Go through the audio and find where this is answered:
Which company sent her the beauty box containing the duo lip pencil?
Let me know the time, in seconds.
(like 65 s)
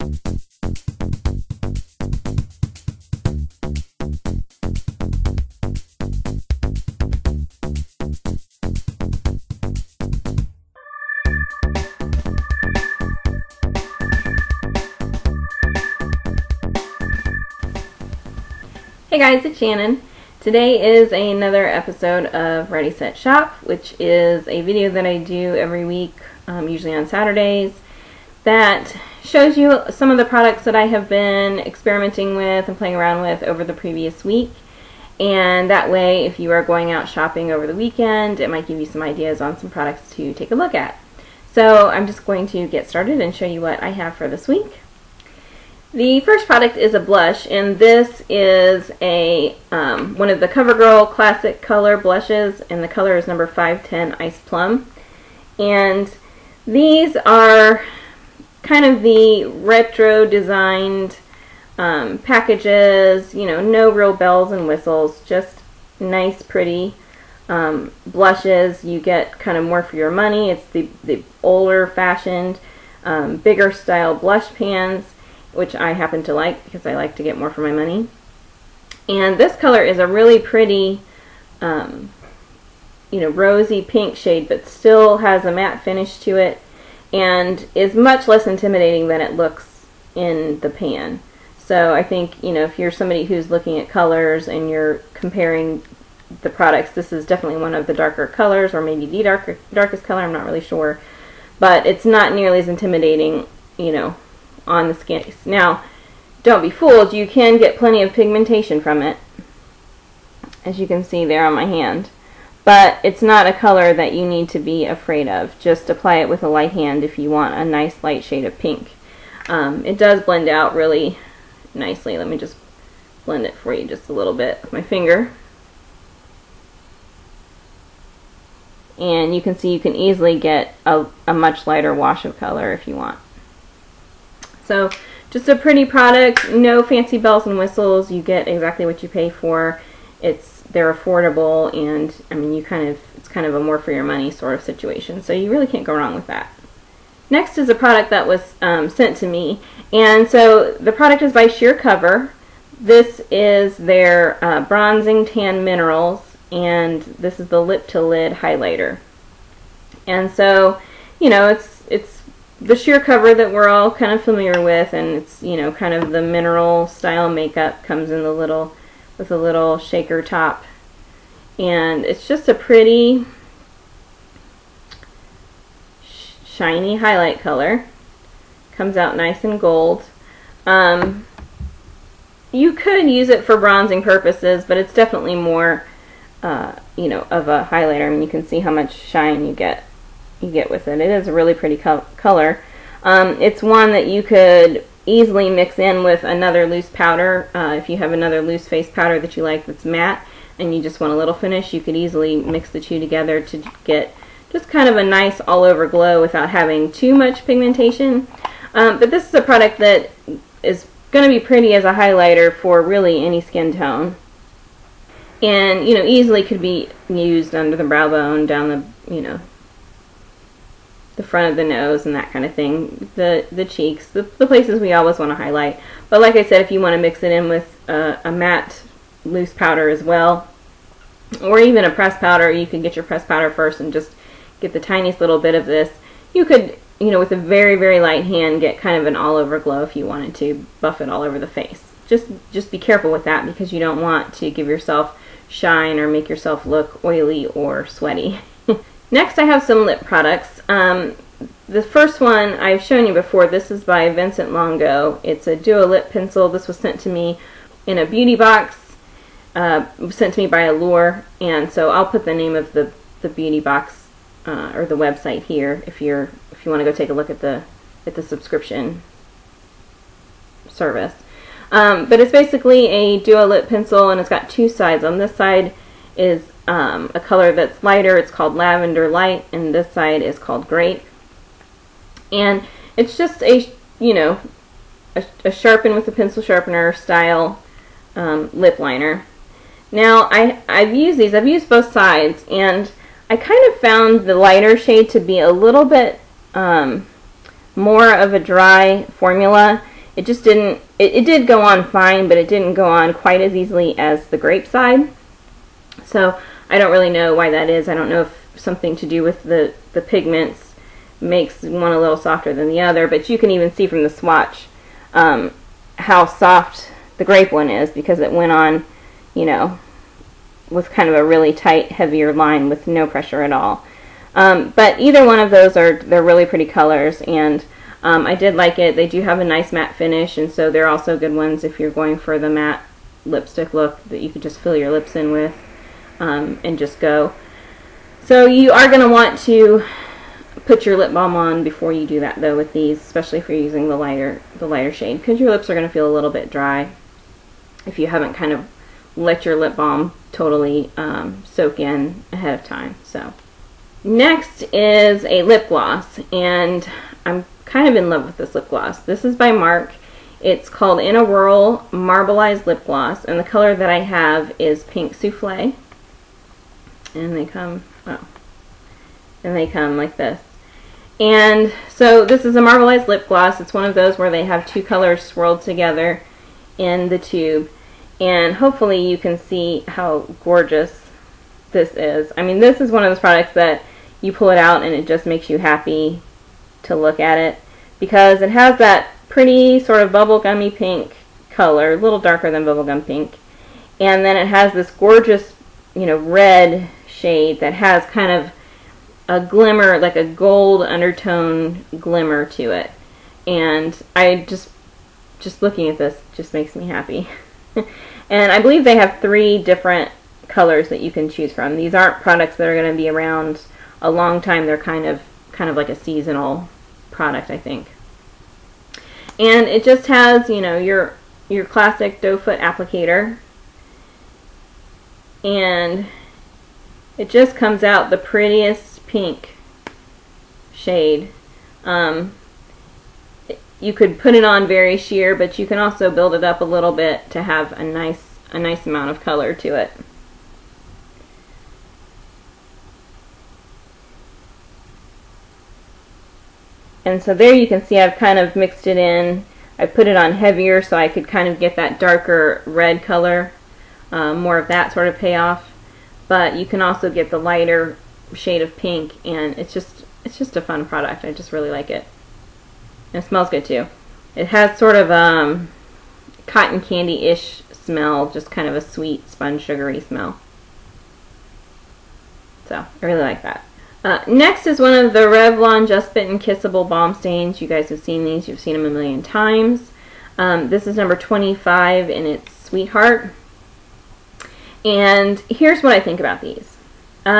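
260 s.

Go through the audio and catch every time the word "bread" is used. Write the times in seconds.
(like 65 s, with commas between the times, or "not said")
not said.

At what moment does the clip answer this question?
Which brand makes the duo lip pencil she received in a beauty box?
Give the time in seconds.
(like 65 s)
254 s.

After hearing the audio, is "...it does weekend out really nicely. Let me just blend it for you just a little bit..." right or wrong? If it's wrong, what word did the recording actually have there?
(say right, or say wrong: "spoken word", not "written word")
wrong: "blend", not "weekend".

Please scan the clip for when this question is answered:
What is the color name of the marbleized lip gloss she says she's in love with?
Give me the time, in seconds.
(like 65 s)
364 s.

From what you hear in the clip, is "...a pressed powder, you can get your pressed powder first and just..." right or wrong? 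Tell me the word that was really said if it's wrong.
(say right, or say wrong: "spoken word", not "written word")
right.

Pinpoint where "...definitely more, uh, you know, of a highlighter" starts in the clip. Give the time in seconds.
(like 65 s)
184 s.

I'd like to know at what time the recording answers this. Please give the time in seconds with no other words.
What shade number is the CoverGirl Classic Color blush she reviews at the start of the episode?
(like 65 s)
53 s.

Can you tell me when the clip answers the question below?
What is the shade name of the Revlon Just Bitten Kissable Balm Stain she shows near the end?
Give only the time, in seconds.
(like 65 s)
482 s.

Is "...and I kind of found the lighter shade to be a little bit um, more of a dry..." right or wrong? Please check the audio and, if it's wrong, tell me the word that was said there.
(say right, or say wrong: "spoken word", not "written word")
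right.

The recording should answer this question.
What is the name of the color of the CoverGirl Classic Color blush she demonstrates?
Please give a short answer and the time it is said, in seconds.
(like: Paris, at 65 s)
Ice Plum, at 54 s.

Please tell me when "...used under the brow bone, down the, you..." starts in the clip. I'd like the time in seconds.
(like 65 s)
217 s.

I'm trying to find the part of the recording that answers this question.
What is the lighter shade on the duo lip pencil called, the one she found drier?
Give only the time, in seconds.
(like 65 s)
278 s.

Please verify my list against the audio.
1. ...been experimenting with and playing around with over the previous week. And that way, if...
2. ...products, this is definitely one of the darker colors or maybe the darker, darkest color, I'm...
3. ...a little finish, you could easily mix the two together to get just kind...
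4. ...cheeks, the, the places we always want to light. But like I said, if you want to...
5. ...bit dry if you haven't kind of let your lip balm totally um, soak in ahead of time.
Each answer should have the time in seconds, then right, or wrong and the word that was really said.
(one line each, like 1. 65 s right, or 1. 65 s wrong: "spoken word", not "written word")
1. 31 s right
2. 96 s right
3. 201 s right
4. 223 s wrong: "highlight", not "light"
5. 346 s right.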